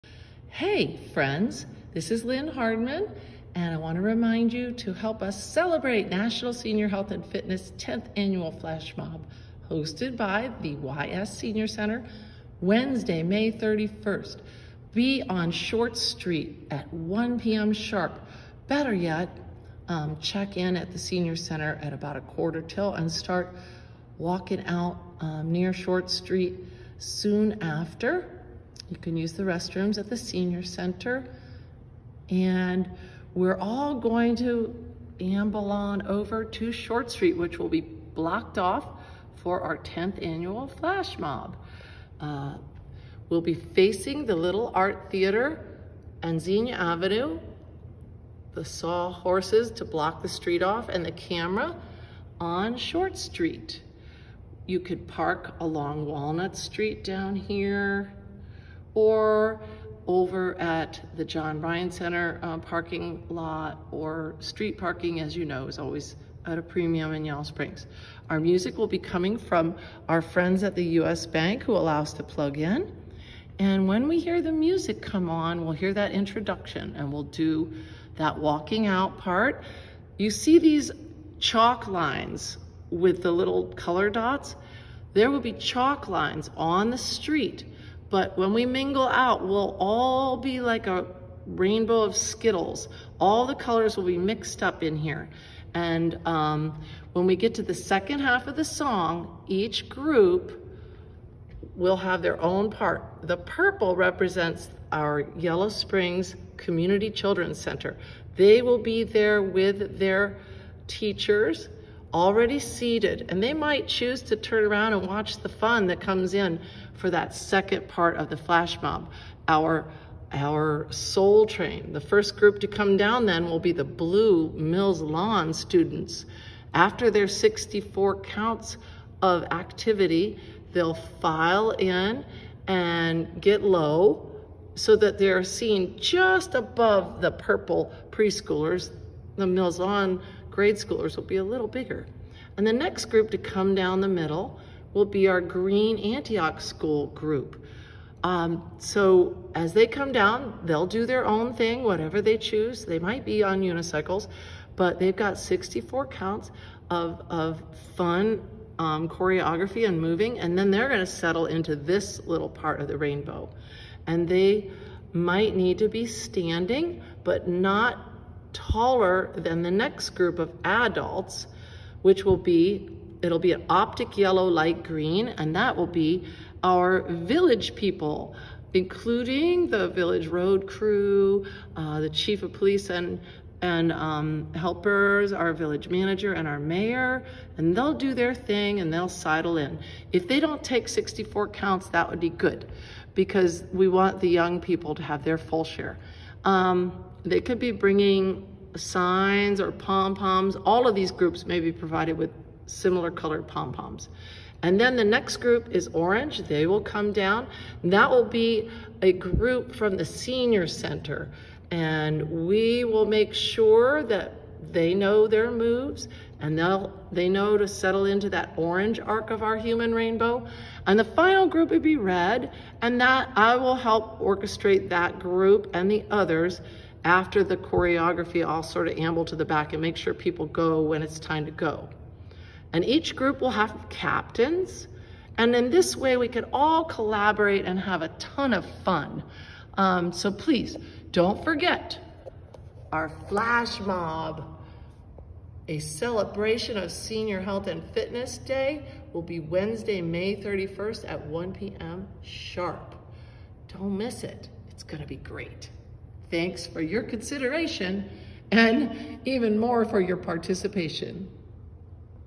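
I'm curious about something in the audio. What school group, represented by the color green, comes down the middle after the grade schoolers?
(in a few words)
Antioch school.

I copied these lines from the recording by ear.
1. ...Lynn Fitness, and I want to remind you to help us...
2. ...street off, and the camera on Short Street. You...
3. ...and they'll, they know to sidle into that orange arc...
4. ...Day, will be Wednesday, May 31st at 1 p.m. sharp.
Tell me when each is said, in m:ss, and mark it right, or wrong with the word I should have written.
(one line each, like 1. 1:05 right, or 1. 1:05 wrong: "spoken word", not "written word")
1. 0:02 wrong: "Hardman", not "Fitness"
2. 0:50 right
3. 3:36 wrong: "settle", not "sidle"
4. 4:08 right.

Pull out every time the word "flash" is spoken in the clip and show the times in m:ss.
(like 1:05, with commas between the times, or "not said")
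0:08, 0:40, 1:58, 4:03.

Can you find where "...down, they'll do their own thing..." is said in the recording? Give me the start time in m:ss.
2:30.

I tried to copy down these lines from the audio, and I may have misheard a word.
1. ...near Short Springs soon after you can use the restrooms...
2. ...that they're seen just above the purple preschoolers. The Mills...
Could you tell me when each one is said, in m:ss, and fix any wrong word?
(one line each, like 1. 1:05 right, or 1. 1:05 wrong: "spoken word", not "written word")
1. 0:25 wrong: "Street", not "Springs"
2. 2:14 right.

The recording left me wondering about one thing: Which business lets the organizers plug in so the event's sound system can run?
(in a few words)
U.S. Bank.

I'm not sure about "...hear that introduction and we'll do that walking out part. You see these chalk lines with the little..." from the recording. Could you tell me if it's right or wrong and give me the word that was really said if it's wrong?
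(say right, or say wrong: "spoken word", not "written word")
right.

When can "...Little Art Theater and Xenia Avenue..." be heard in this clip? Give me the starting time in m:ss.
0:44.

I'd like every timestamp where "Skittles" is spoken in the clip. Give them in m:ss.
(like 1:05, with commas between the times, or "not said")
1:32.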